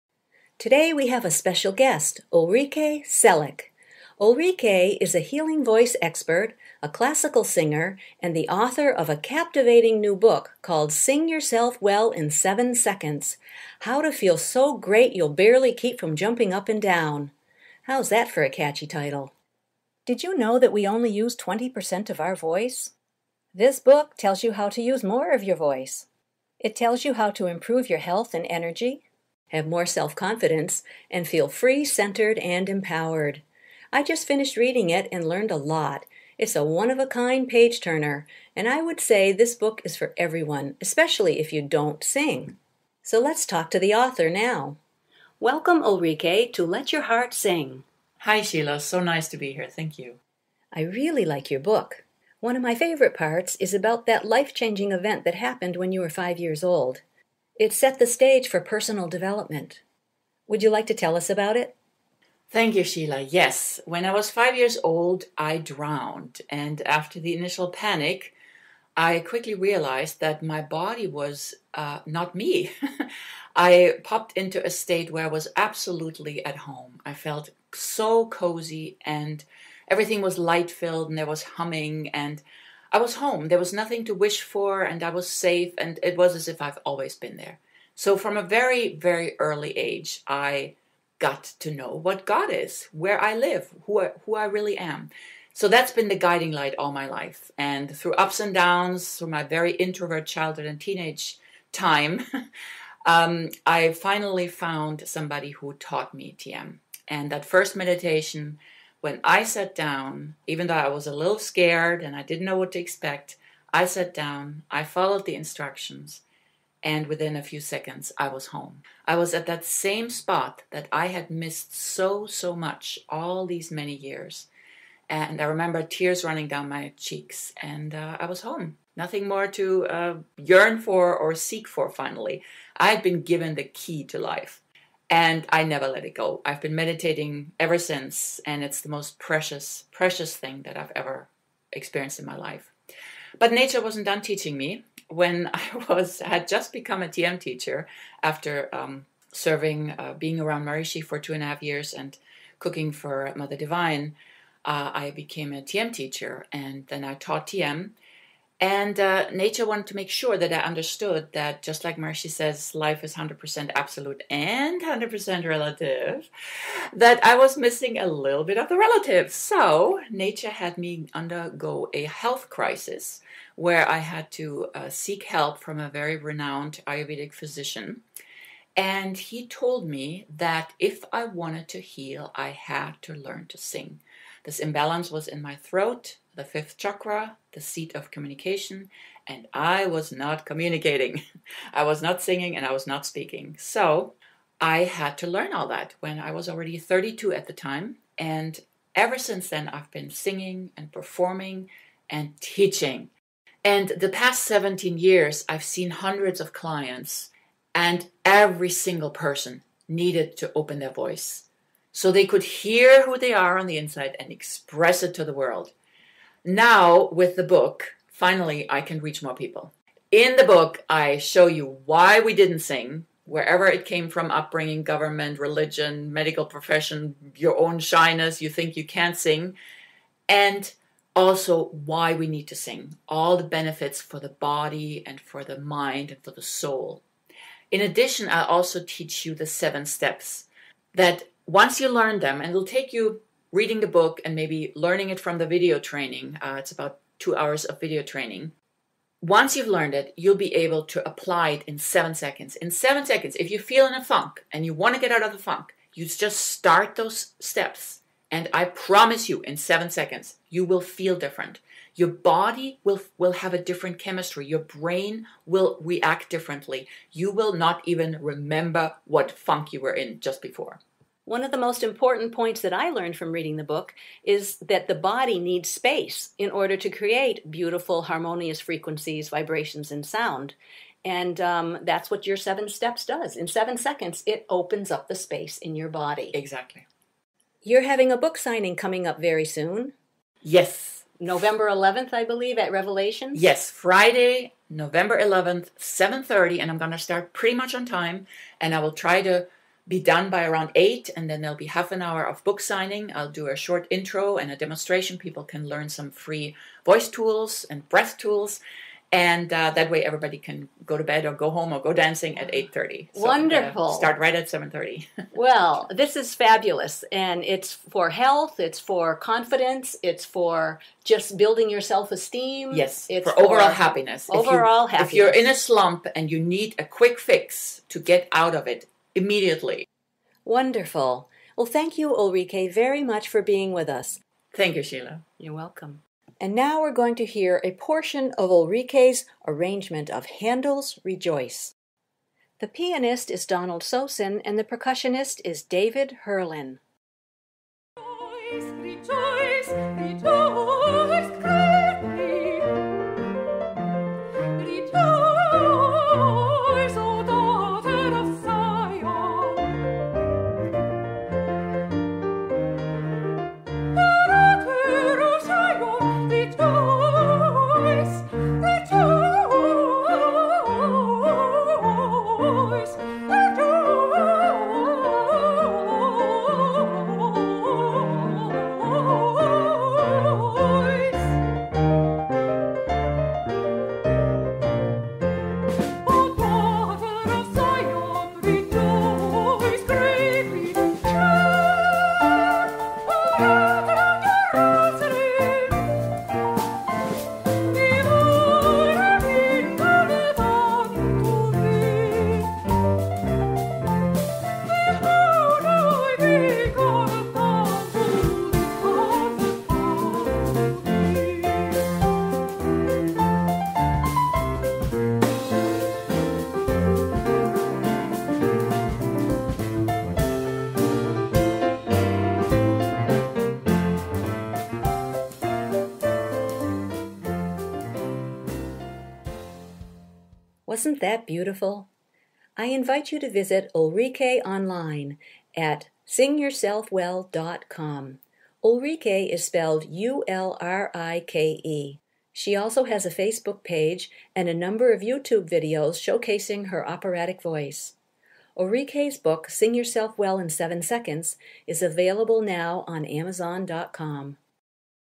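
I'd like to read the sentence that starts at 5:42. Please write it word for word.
The pianist is Donald Sosin, and the percussionist is David Herlin.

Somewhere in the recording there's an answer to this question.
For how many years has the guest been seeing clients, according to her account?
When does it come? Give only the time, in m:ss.
3:24.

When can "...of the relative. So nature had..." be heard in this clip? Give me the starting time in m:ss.
2:48.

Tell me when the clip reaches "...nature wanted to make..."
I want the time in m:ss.
2:39.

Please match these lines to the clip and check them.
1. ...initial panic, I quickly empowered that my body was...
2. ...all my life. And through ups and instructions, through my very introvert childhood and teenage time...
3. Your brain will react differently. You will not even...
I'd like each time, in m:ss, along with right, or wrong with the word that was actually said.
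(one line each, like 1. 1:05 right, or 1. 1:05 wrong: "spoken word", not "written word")
1. 1:07 wrong: "realized", not "empowered"
2. 1:36 wrong: "downs", not "instructions"
3. 4:24 right.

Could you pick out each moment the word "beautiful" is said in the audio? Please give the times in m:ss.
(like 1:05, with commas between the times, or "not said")
4:37, 7:11.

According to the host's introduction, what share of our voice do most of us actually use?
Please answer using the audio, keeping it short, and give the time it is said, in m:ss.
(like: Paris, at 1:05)
20%, at 0:21.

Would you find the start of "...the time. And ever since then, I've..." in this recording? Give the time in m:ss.
3:17.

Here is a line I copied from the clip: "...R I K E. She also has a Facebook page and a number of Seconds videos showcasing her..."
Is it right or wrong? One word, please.
wrong.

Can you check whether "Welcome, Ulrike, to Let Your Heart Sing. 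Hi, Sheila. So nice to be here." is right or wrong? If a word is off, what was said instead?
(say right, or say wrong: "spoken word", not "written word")
right.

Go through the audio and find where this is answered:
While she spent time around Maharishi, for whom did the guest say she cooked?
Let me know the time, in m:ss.
2:33.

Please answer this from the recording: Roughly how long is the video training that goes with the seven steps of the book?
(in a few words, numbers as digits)
2 hours.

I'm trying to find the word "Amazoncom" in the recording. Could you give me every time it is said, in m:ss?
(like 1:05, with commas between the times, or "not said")
7:33.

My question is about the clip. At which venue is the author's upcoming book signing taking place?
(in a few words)
Revelations.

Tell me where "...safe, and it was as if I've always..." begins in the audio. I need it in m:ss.
1:25.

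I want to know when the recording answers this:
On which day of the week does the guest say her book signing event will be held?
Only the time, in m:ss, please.
4:53.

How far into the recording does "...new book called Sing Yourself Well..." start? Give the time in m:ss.
0:09.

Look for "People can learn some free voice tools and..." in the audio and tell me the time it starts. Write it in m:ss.
5:05.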